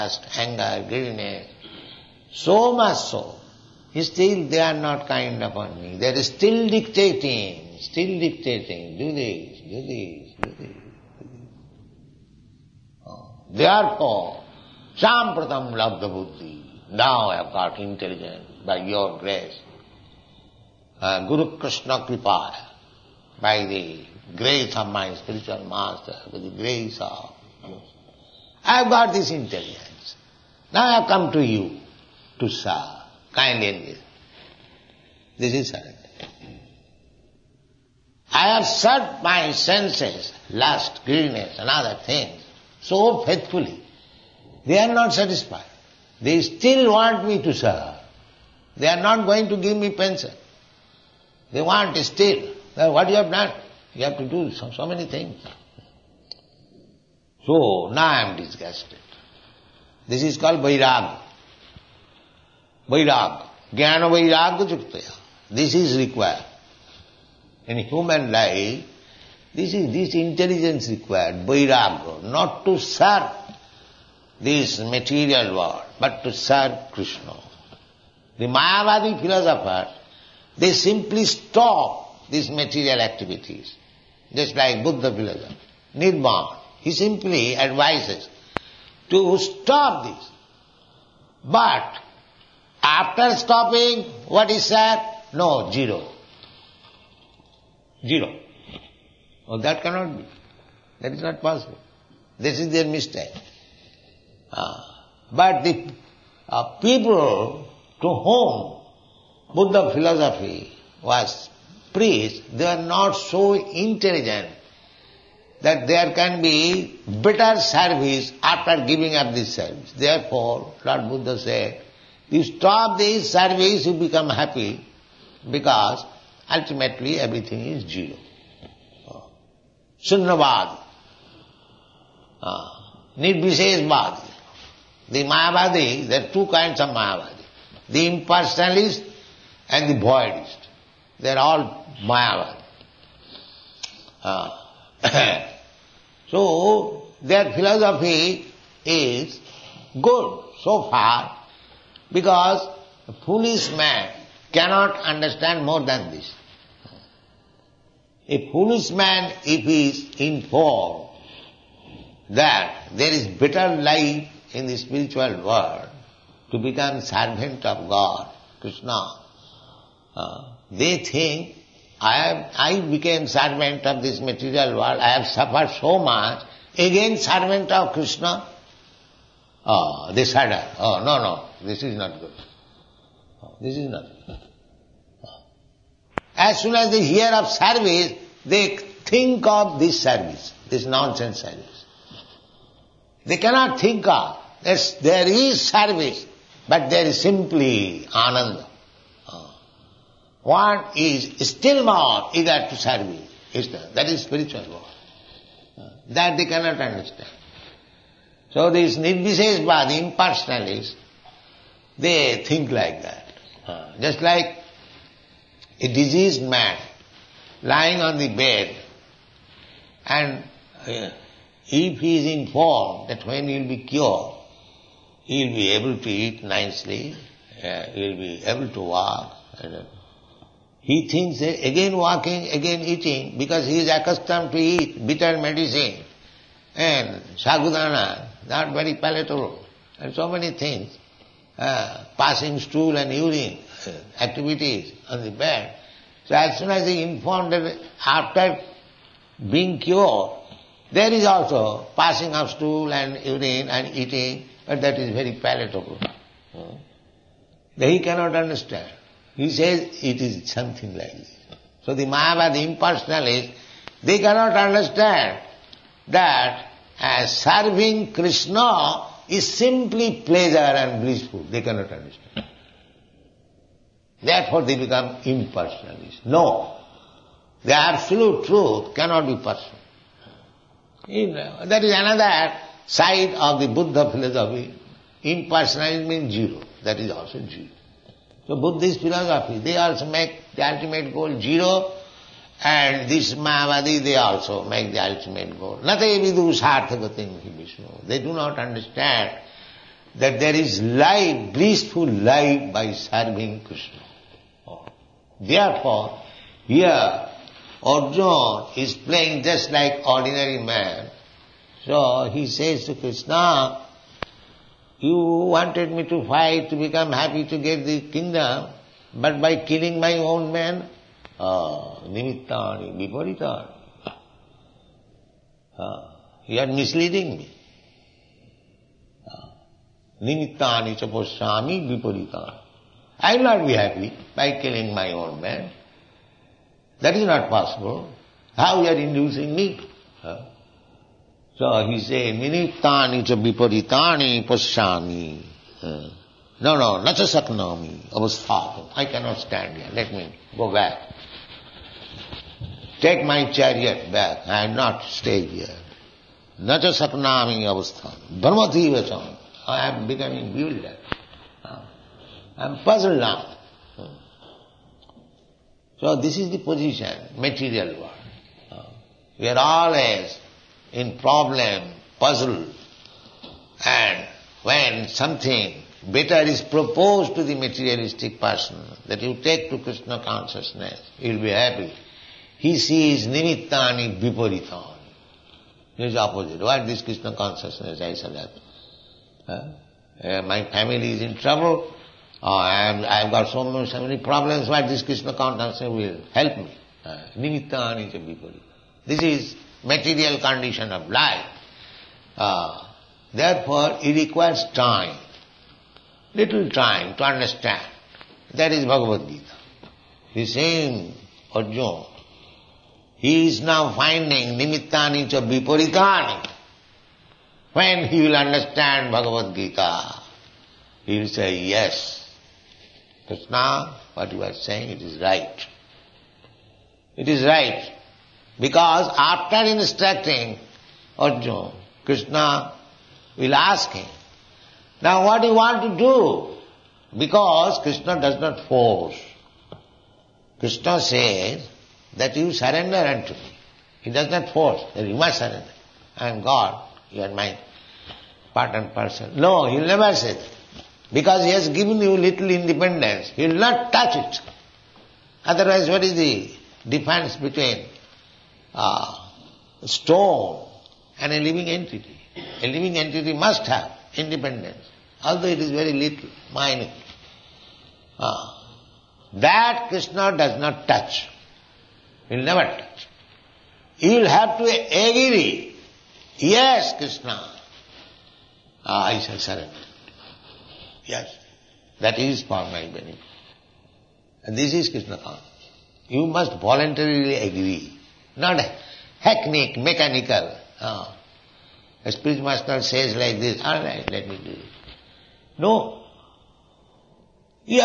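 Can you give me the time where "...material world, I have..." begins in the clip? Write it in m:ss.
2:54.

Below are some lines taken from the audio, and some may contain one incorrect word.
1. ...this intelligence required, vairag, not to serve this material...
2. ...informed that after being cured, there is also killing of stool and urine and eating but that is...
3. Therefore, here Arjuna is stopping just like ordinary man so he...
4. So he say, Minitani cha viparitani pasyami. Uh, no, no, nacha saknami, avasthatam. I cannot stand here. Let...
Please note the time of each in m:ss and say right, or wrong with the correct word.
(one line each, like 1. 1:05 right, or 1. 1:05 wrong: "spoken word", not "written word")
1. 1:09 right
2. 4:07 wrong: "passing", not "killing"
3. 5:05 wrong: "playing", not "stopping"
4. 5:41 right.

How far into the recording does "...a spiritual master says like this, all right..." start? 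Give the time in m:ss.
8:12.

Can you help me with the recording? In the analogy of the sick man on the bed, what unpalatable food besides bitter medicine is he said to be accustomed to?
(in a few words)
sagudana.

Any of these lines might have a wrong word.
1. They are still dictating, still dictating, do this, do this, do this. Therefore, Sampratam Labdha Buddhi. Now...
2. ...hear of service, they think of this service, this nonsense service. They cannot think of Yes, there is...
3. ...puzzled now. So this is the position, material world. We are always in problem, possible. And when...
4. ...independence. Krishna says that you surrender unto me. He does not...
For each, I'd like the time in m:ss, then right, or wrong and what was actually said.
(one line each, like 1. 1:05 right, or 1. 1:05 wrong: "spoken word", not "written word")
1. 0:06 right
2. 3:07 right
3. 6:02 wrong: "puzzle", not "possible"
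4. 7:18 wrong: "force", not "independence".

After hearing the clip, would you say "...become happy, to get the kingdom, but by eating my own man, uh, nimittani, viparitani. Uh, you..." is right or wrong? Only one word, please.
wrong.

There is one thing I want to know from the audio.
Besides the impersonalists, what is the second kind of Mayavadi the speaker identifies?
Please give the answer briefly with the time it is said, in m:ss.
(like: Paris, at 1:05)
the voidist, at 2:19.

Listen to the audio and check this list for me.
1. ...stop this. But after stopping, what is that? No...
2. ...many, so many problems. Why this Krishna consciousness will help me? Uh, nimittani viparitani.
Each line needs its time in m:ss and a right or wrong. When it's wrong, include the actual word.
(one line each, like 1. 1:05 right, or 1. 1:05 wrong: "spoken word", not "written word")
1. 1:29 right
2. 6:33 right.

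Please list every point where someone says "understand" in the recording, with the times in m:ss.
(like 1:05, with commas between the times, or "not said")
2:35, 3:26, 4:18, 4:24, 4:31, 4:58, 6:47, 6:58.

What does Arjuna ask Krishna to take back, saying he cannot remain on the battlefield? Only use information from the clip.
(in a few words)
my chariot.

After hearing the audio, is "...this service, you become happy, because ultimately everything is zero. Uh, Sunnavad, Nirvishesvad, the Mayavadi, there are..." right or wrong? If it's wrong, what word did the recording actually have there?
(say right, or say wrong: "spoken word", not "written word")
right.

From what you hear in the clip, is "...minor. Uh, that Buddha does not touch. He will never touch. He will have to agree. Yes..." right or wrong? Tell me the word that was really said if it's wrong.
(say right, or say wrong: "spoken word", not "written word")
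wrong: "Krishna", not "Buddha".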